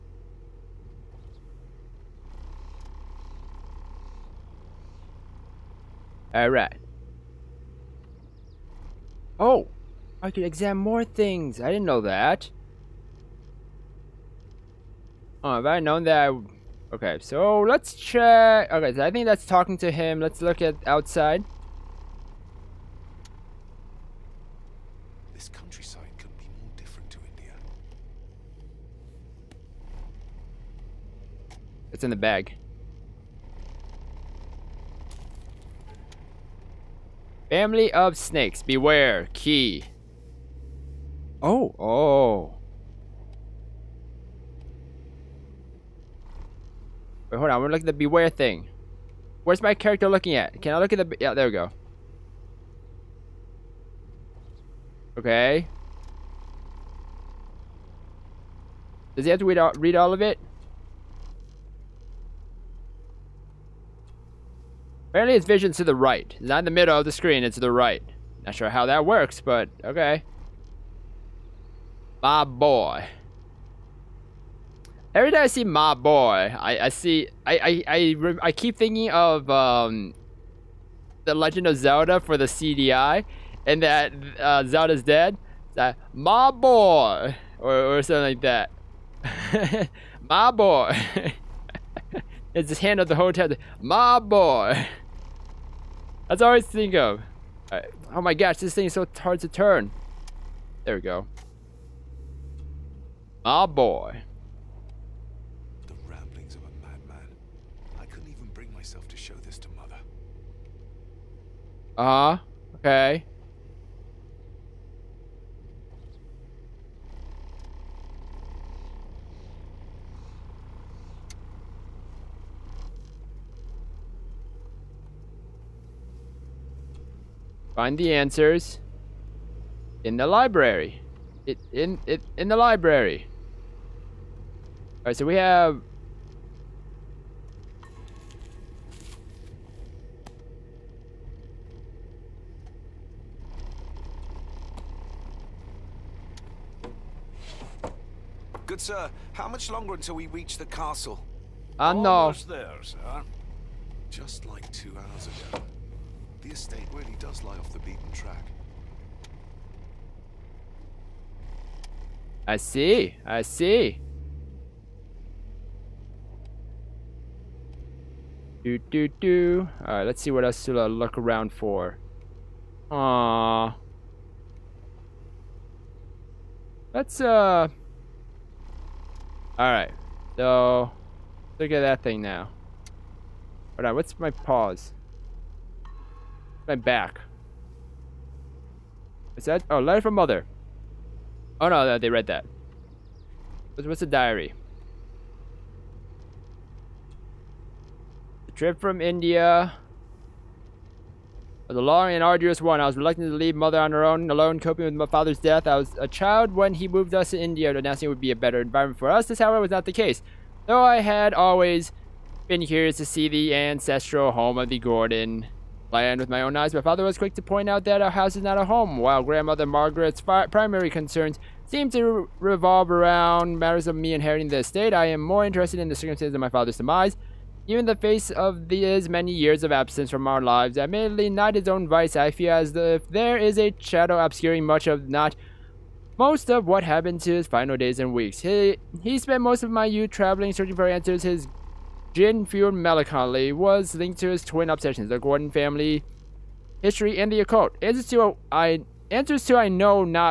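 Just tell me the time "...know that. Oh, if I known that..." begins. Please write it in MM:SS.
00:11.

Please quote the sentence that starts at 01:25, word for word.
That my boy or or something like that.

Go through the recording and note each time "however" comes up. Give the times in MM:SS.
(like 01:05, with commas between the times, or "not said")
03:29.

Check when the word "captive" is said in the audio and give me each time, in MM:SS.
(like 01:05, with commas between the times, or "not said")
not said.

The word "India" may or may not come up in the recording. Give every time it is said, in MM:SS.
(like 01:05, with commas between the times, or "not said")
00:27, 03:19, 03:27.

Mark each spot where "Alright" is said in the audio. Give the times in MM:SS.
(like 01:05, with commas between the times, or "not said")
00:06, 02:15.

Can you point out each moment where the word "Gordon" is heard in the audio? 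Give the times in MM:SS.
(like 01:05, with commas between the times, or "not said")
03:34, 04:05.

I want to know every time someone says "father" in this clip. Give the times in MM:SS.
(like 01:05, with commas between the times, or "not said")
03:25, 03:36, 03:46.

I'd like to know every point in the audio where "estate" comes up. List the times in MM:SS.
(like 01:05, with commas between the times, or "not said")
02:36, 03:44.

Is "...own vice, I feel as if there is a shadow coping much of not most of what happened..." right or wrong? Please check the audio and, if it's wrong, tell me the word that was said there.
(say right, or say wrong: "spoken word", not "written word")
wrong: "obscuring", not "coping".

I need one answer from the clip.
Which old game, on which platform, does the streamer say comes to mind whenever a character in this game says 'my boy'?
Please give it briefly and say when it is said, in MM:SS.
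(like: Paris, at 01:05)
The Legend of Zelda for the CD-i, at 01:21.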